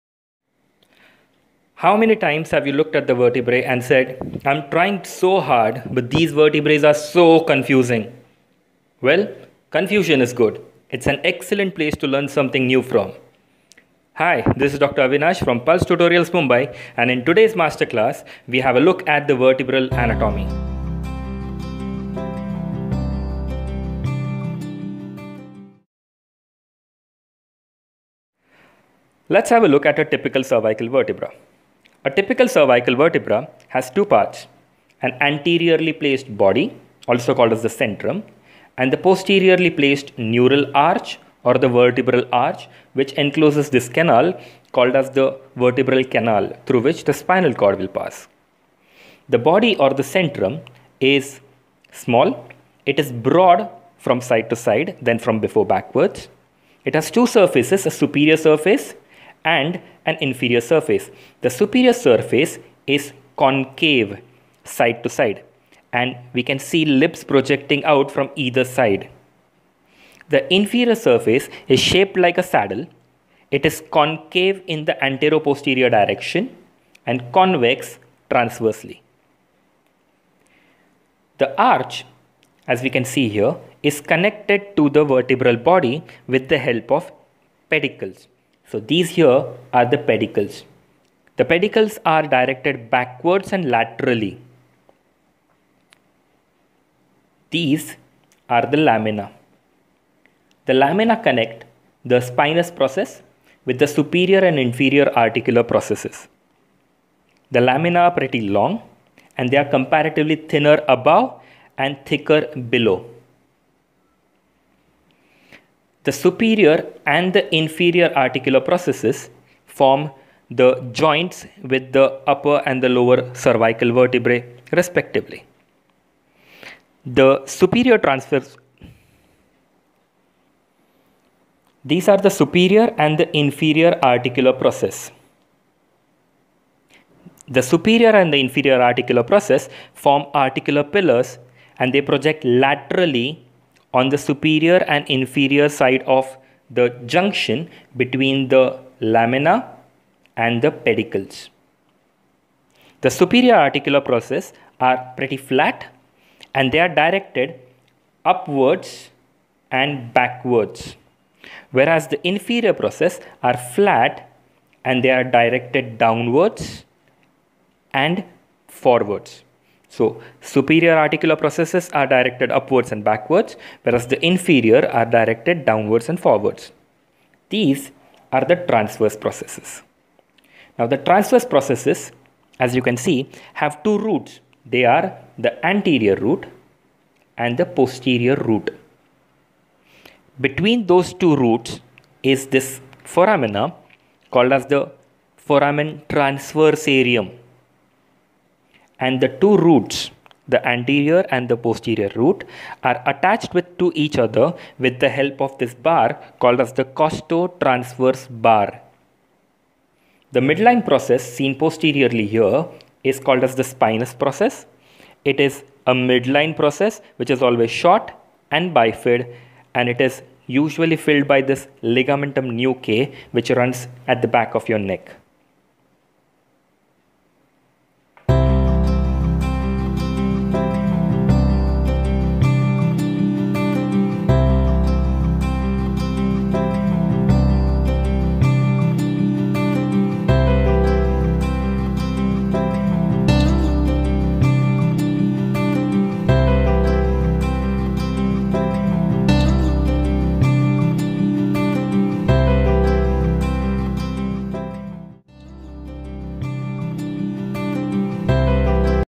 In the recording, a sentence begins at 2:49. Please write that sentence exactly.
So superior articular processes are directed upwards and backwards, whereas the inferior are directed downwards and forwards.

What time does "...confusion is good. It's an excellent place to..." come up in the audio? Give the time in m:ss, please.
0:09.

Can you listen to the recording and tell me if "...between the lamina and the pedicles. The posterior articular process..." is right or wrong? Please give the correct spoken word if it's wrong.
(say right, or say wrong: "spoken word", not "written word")
wrong: "superior", not "posterior".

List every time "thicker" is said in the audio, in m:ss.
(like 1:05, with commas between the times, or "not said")
1:52.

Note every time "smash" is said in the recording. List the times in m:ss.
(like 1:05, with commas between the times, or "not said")
not said.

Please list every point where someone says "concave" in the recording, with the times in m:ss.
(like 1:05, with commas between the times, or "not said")
1:03, 1:13.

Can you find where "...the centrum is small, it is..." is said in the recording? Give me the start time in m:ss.
0:49.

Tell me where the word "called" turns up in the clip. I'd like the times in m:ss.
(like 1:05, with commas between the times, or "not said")
0:37, 0:44, 3:14, 3:26, 3:33.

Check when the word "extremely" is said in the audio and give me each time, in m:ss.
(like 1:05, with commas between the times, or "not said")
not said.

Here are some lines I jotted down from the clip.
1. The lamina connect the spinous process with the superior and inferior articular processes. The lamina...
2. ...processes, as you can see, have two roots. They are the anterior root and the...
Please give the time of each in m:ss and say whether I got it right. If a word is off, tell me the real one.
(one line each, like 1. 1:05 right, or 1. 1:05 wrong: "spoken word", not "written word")
1. 1:40 right
2. 3:01 right.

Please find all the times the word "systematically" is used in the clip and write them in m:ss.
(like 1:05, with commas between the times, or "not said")
not said.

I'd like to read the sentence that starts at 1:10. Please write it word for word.
The inferior surface is shaped like a saddle.